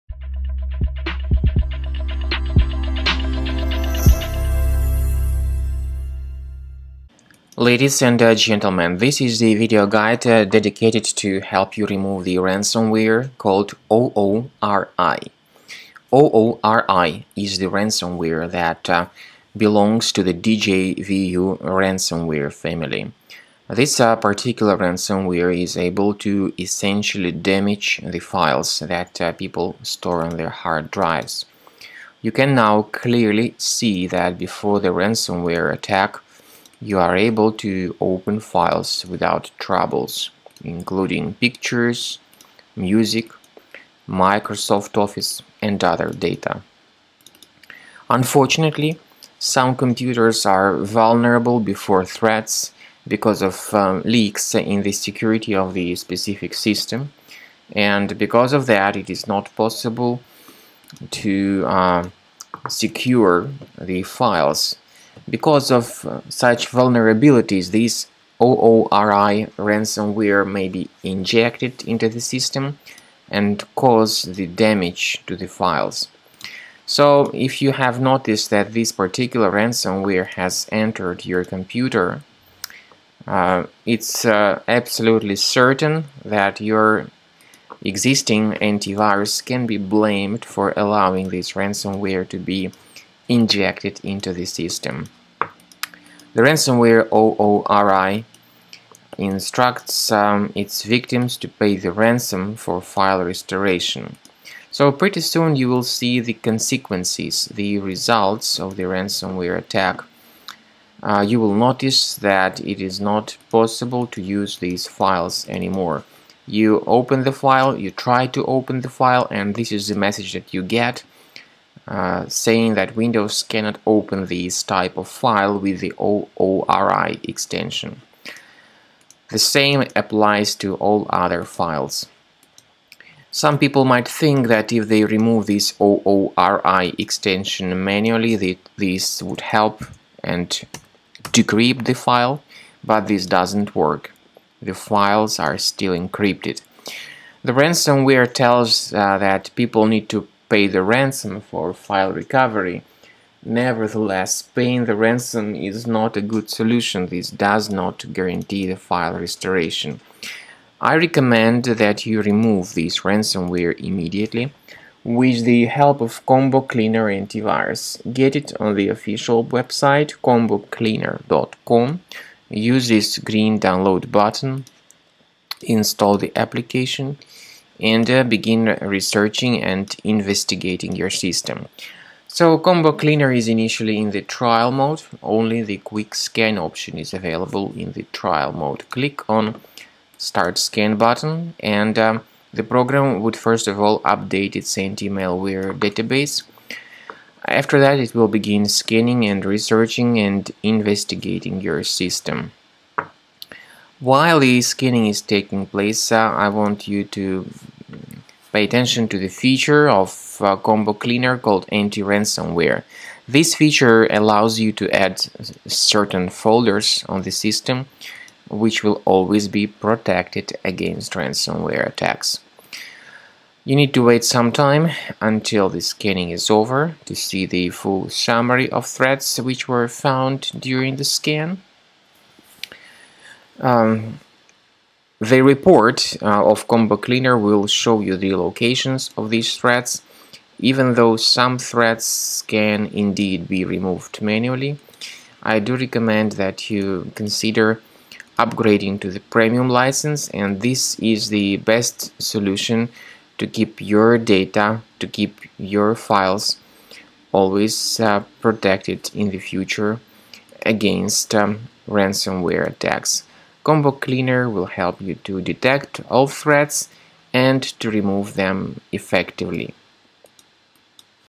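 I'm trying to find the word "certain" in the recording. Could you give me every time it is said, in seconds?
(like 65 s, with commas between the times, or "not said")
85 s, 215 s.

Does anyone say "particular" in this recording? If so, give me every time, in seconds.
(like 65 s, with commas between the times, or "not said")
24 s, 78 s.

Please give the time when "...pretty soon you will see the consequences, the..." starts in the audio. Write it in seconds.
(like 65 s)
104 s.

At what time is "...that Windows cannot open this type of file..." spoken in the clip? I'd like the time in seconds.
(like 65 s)
122 s.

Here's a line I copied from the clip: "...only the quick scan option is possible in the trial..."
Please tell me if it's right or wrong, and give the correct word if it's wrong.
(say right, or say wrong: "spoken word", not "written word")
wrong: "available", not "possible".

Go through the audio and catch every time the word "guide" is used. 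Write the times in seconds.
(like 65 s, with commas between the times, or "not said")
9 s.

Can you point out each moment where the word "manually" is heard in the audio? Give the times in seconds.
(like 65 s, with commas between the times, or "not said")
137 s, 244 s.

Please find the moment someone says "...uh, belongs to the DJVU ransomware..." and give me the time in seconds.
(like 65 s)
18 s.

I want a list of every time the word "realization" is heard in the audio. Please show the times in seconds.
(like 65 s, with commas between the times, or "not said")
not said.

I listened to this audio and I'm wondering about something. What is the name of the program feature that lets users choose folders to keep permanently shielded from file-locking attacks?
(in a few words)
anti-ransomware.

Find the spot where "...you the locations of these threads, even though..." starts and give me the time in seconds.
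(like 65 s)
238 s.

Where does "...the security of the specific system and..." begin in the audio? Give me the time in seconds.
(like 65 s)
54 s.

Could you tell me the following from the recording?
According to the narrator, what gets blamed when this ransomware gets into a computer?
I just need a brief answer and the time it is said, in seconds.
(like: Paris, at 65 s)
your existing antivirus, at 86 s.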